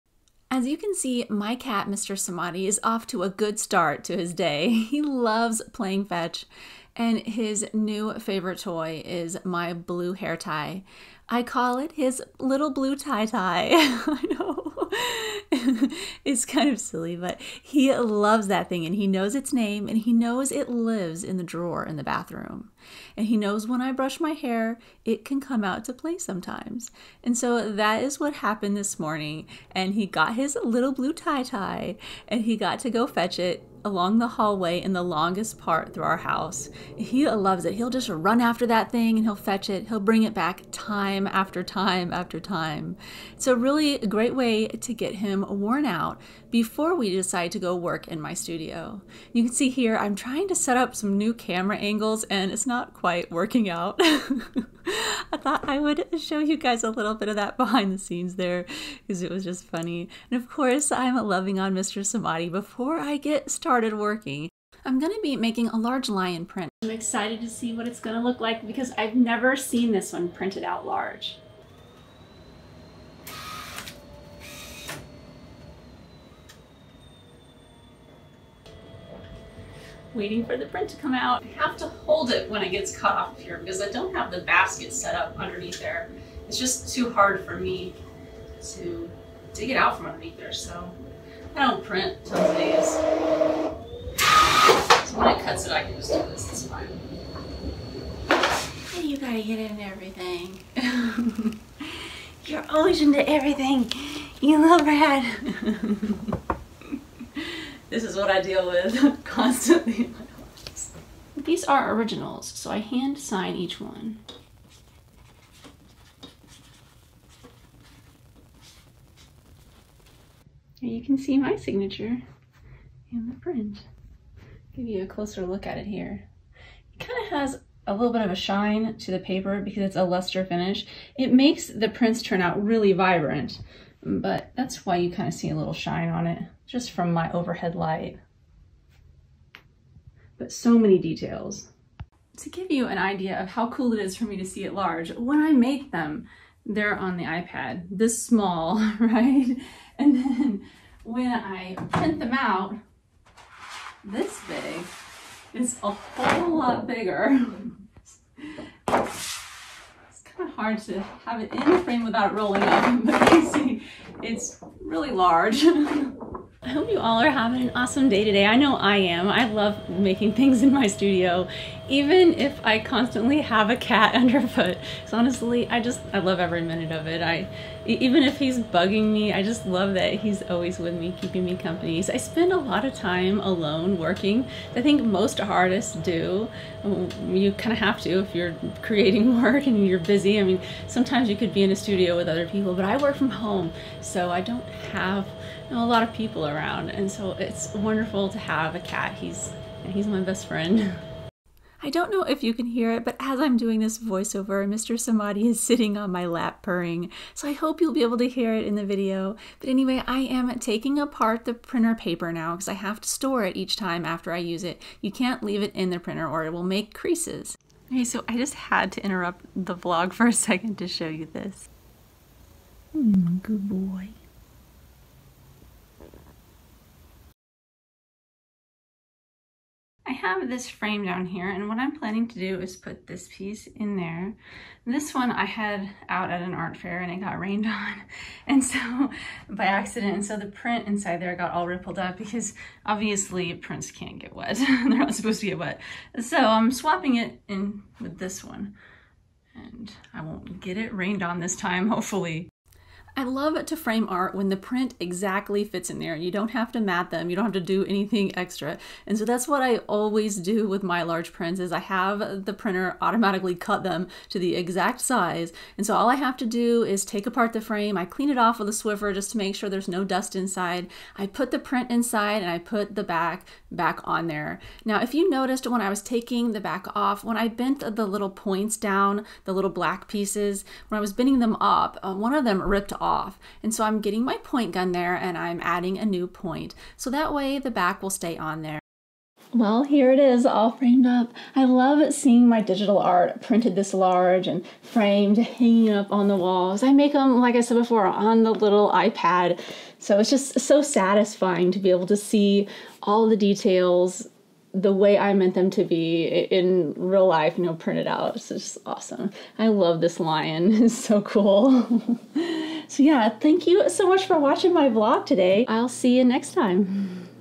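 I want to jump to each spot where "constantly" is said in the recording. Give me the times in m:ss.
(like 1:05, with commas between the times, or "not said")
1:49, 2:52.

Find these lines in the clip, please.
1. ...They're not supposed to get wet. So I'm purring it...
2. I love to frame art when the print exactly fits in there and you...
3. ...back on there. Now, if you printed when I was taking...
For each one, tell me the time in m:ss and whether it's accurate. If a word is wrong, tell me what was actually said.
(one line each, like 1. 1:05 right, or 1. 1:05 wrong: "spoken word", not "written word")
1. 4:04 wrong: "swapping", not "purring"
2. 4:13 right
3. 4:33 wrong: "noticed", not "printed".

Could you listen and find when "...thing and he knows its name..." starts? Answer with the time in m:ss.
0:18.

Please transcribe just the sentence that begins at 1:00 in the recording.
And of course, I'm loving on Mr.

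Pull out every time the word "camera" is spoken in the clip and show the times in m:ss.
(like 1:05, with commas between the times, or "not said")
0:51.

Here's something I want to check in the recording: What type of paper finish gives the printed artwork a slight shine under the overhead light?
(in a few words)
luster.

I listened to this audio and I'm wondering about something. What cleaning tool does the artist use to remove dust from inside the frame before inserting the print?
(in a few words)
Swiffer.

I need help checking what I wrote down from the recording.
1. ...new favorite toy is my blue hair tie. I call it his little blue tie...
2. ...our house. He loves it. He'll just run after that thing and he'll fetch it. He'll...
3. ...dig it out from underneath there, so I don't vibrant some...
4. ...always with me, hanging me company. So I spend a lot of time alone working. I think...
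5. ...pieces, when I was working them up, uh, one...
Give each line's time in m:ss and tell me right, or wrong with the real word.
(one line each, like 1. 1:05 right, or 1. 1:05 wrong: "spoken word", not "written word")
1. 0:07 right
2. 0:36 right
3. 1:29 wrong: "print", not "vibrant"
4. 3:00 wrong: "keeping", not "hanging"
5. 4:40 wrong: "bending", not "working".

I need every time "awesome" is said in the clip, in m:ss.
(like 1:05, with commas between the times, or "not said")
2:47, 5:08.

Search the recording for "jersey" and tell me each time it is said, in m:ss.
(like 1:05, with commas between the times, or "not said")
not said.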